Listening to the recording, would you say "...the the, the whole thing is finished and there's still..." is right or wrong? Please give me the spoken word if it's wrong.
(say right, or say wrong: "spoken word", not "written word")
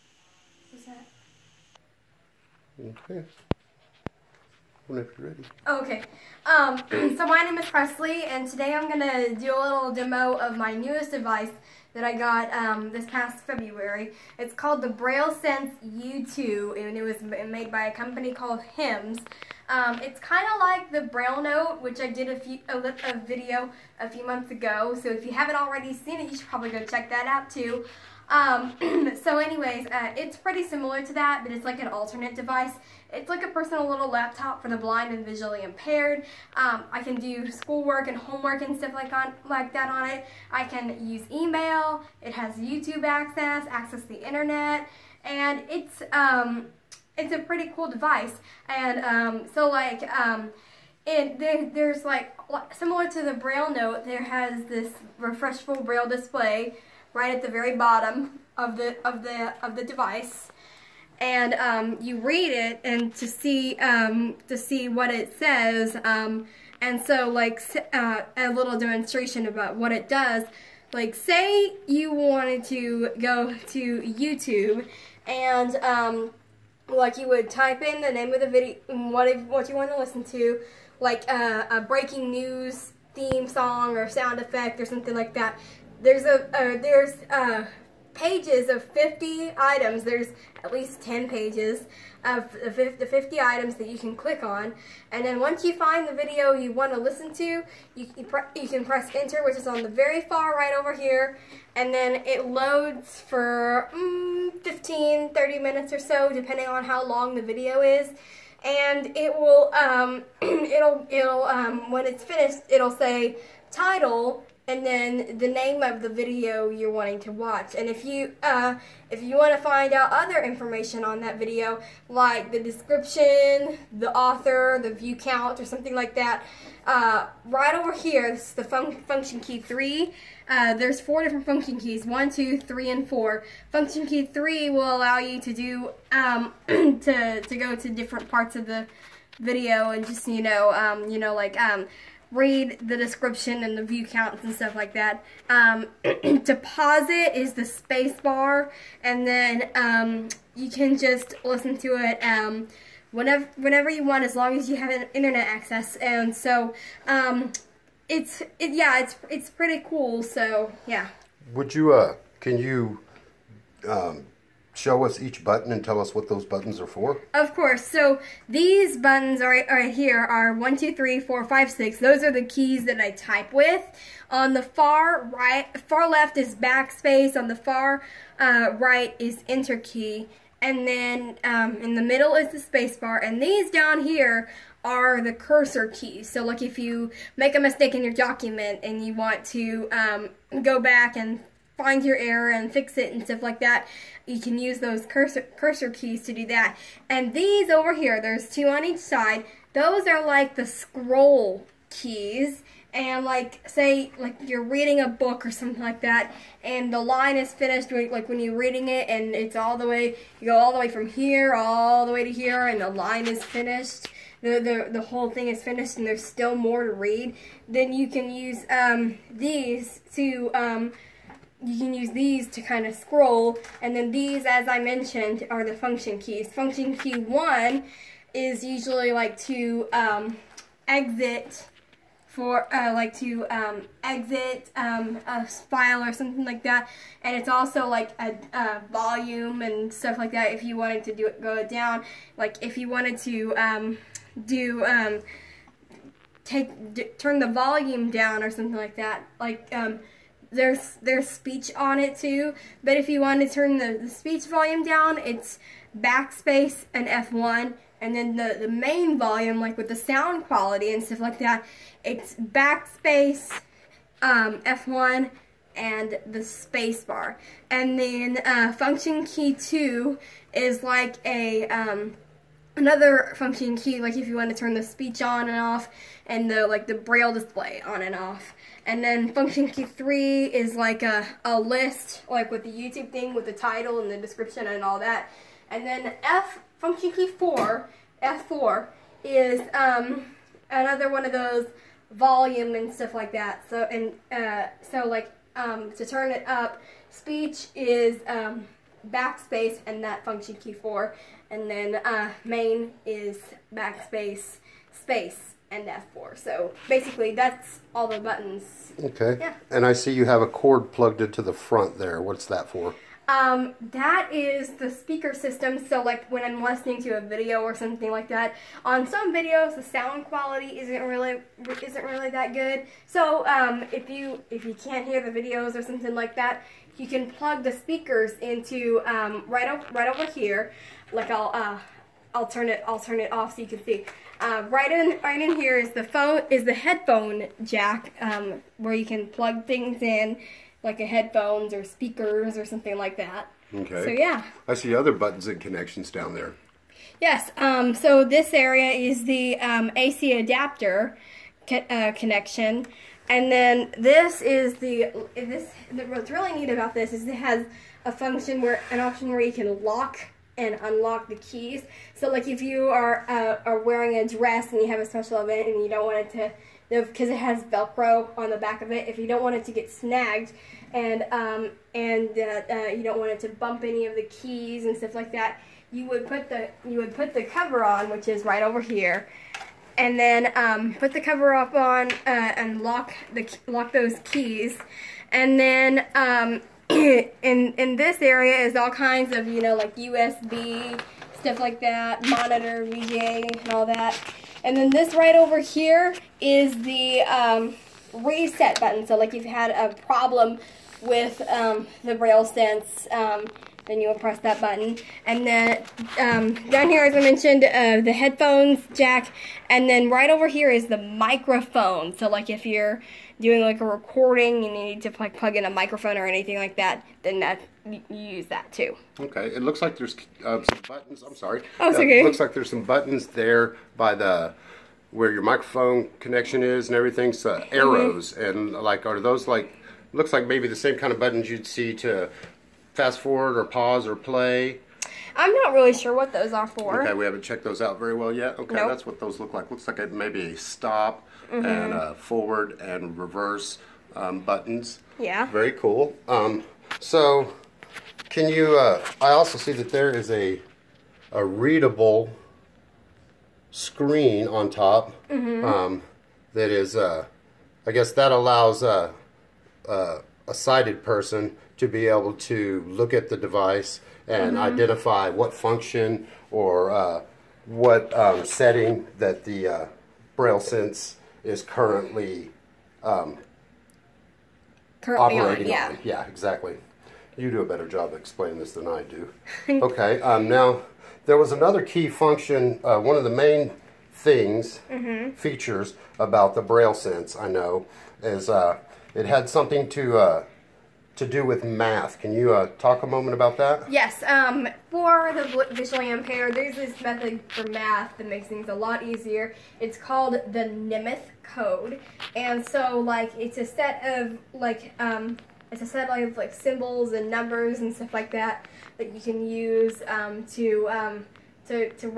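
right.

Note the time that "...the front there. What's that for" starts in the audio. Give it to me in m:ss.
5:11.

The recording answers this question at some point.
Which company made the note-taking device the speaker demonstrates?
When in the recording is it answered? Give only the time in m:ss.
0:18.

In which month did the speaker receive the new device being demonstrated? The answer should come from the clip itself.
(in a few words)
February.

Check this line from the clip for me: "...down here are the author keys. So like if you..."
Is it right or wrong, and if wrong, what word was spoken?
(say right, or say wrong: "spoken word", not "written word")
wrong: "cursor", not "author".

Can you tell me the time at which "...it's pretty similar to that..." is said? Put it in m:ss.
0:30.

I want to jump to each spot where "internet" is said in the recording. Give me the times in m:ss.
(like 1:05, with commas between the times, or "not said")
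0:44, 2:35.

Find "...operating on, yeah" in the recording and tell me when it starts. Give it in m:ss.
7:55.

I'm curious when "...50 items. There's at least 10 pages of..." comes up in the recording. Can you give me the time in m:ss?
1:28.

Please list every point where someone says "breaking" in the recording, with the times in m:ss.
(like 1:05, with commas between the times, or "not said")
1:21.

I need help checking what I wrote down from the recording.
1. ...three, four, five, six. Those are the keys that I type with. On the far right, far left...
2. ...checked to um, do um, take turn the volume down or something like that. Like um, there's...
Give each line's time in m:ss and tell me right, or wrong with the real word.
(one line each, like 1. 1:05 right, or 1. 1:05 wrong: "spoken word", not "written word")
1. 2:50 right
2. 4:02 wrong: "wanted", not "checked".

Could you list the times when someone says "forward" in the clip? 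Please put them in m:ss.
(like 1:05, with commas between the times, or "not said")
7:13, 7:22.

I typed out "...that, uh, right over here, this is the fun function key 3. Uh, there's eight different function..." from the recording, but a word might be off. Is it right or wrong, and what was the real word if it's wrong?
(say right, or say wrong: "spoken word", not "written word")
wrong: "four", not "eight".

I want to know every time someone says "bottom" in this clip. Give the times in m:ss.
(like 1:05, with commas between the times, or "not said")
0:57.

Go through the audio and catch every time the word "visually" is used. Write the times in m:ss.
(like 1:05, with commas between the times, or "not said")
0:35, 8:15.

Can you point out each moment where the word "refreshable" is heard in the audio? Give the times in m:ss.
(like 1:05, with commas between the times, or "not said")
0:55.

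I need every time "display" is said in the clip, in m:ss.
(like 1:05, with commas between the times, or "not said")
0:56, 4:37.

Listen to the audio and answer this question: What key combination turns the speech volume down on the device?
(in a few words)
Backspace and F1.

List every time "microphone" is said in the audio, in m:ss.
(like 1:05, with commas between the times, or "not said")
6:50, 6:55, 7:05.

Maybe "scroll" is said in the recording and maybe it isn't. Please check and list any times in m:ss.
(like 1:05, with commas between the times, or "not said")
3:20, 3:42.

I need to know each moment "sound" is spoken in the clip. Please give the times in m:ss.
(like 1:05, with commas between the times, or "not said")
1:24, 4:19, 5:19.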